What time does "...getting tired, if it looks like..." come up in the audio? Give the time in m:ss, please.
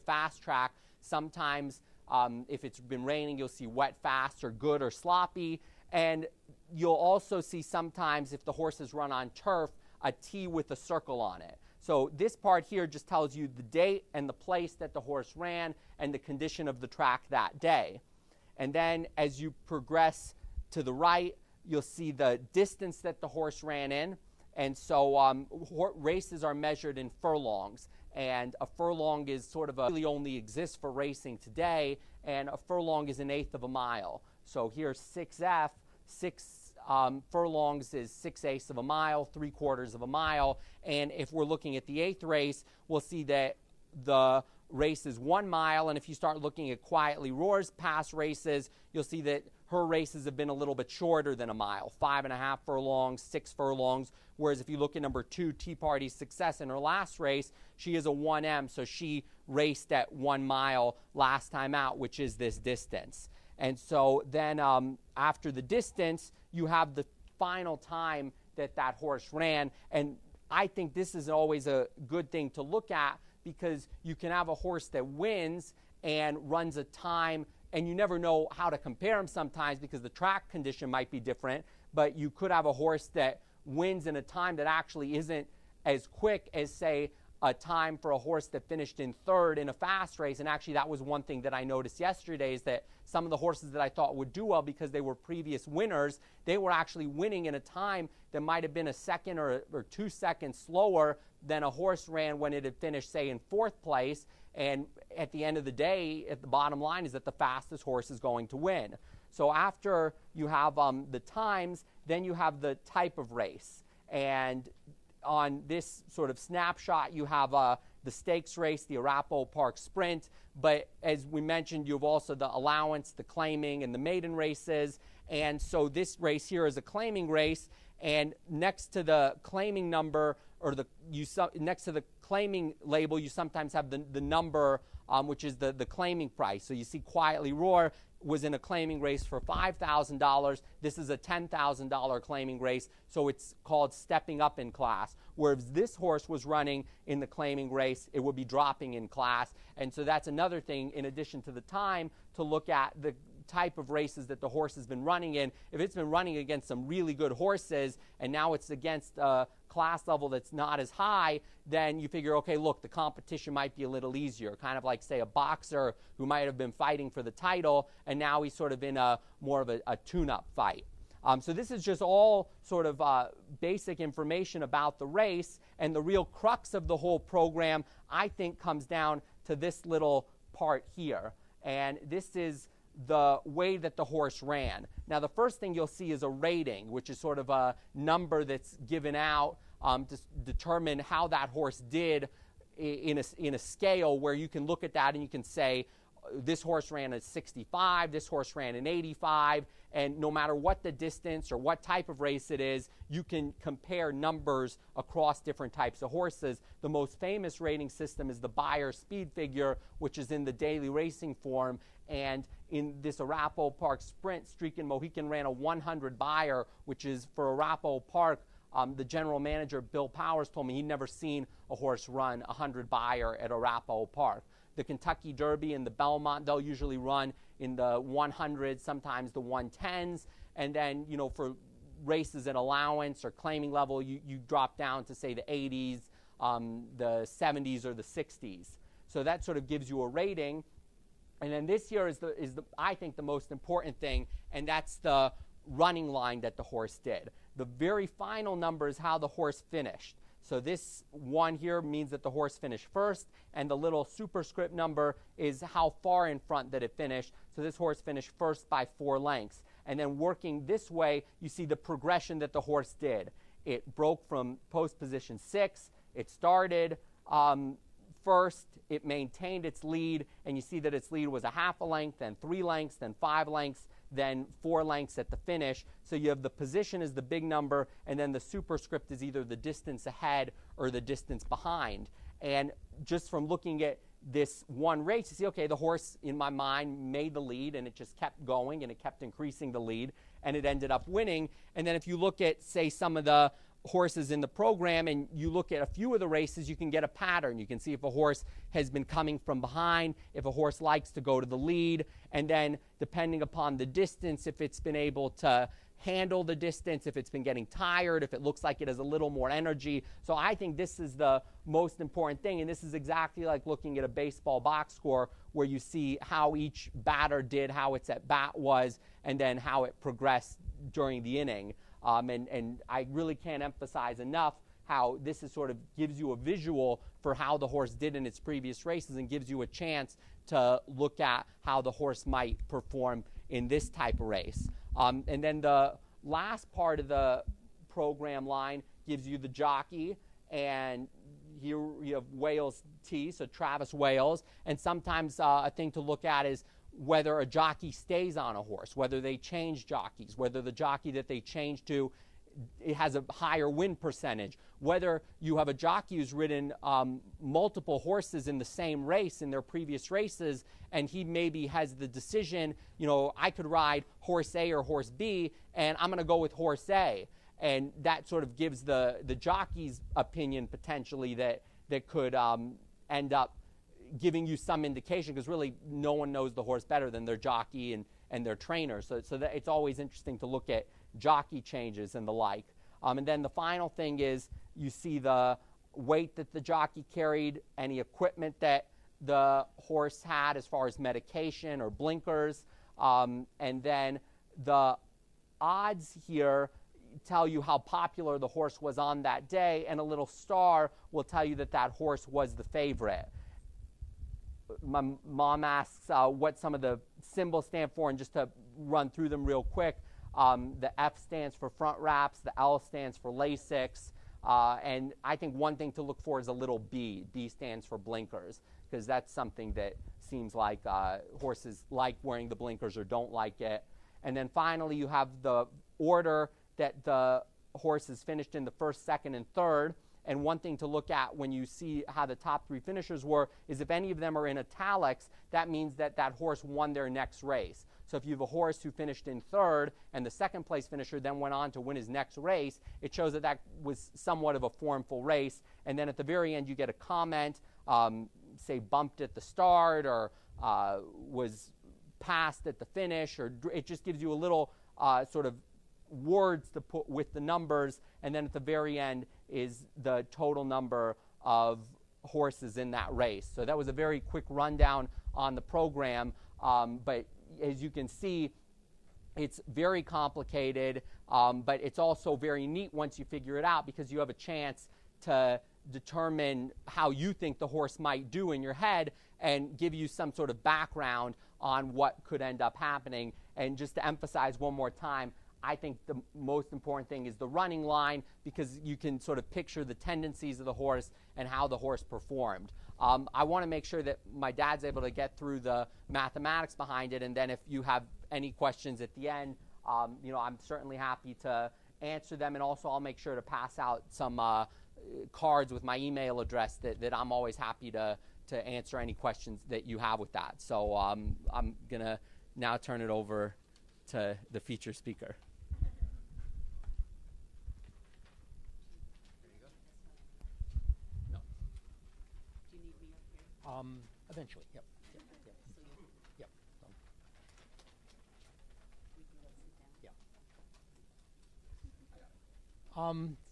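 5:07.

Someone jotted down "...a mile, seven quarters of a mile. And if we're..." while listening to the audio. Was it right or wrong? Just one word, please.
wrong.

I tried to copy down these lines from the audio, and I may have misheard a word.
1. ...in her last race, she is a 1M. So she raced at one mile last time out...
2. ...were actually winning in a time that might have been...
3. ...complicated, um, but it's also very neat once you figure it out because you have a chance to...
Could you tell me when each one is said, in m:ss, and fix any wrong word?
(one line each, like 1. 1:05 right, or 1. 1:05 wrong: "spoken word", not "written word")
1. 0:56 right
2. 1:36 right
3. 7:50 right.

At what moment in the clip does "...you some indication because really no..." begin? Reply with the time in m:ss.
6:14.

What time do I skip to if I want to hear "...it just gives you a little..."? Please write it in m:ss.
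7:33.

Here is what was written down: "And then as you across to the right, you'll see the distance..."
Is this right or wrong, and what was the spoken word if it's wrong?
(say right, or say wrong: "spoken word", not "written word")
wrong: "progress", not "across".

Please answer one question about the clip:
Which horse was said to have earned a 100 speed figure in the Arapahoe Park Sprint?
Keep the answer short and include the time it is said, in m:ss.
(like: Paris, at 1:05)
Streakin Mohican, at 3:34.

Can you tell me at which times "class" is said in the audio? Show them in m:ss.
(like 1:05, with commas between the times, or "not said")
2:24, 2:29, 2:39.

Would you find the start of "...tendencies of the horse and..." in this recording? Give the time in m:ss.
8:09.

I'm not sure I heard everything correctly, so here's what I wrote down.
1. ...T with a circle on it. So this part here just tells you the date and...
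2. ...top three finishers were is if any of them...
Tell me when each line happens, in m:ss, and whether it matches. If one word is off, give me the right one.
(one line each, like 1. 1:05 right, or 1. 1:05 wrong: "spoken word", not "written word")
1. 0:10 right
2. 7:12 right.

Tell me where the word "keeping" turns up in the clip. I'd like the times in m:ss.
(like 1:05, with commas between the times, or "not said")
not said.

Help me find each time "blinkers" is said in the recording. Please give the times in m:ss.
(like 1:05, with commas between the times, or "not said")
6:31, 6:57, 7:02.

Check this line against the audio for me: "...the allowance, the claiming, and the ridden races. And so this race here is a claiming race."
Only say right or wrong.
wrong.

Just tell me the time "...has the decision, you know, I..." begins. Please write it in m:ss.
6:01.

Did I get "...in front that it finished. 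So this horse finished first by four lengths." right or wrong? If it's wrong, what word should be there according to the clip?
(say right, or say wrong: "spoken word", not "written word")
right.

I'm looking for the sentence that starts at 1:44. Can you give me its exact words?
And at the end of the day, at the bottom line is that the fastest horse is going to win.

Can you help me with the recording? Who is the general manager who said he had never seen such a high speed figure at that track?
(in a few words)
Bill Powers.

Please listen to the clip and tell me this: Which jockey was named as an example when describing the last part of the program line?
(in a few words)
Travis Wales.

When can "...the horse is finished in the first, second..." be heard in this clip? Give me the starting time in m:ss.
7:07.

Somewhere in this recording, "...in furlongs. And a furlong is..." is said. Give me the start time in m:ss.
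0:26.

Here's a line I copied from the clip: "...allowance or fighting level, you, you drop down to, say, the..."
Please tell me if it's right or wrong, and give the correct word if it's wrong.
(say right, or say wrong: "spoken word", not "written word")
wrong: "claiming", not "fighting".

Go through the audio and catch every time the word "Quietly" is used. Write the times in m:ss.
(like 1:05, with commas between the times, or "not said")
0:46, 2:16.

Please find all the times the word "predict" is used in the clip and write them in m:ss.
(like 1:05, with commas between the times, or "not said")
not said.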